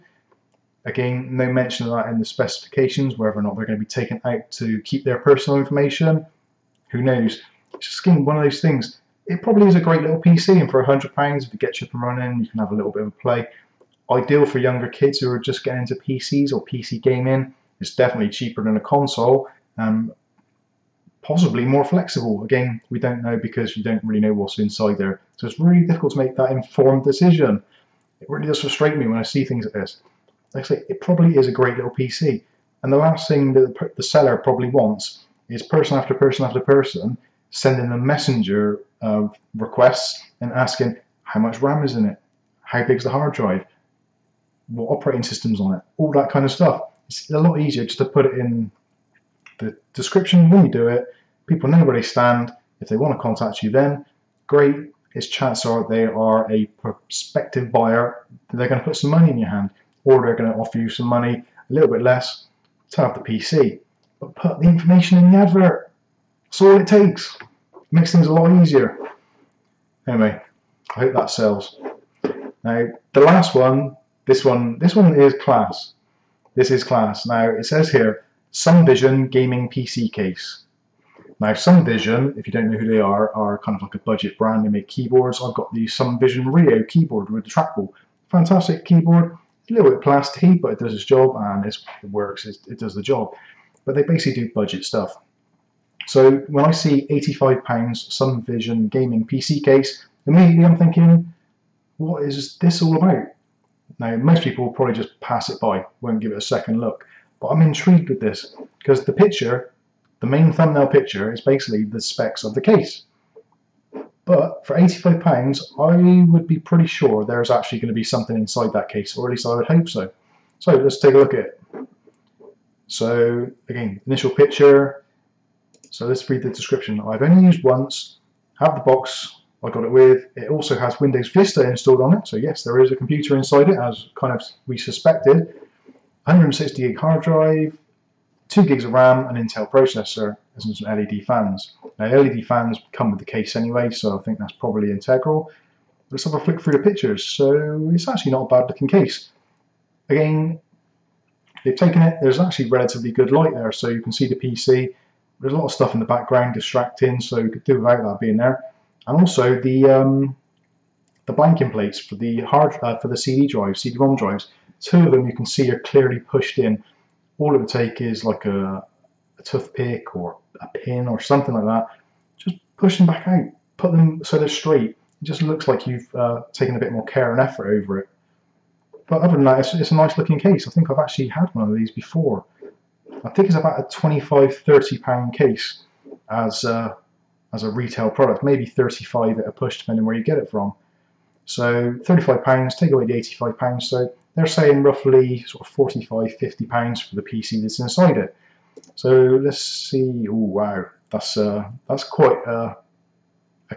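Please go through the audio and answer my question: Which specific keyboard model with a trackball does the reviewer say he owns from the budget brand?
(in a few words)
Sumvision Rio.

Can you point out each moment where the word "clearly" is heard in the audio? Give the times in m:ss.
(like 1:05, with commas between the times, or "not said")
2:45.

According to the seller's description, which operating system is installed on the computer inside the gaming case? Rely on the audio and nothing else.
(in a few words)
Windows Vista.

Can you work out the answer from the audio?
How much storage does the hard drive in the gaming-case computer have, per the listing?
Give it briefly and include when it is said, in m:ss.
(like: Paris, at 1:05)
160 GB, at 2:16.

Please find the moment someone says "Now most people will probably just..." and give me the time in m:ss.
1:43.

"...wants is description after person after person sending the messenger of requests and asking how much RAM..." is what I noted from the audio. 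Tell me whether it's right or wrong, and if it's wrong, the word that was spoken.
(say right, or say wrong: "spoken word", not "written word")
wrong: "person", not "description".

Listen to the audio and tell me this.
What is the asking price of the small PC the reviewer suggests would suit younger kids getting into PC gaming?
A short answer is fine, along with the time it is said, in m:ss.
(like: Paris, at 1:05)
£100, at 0:10.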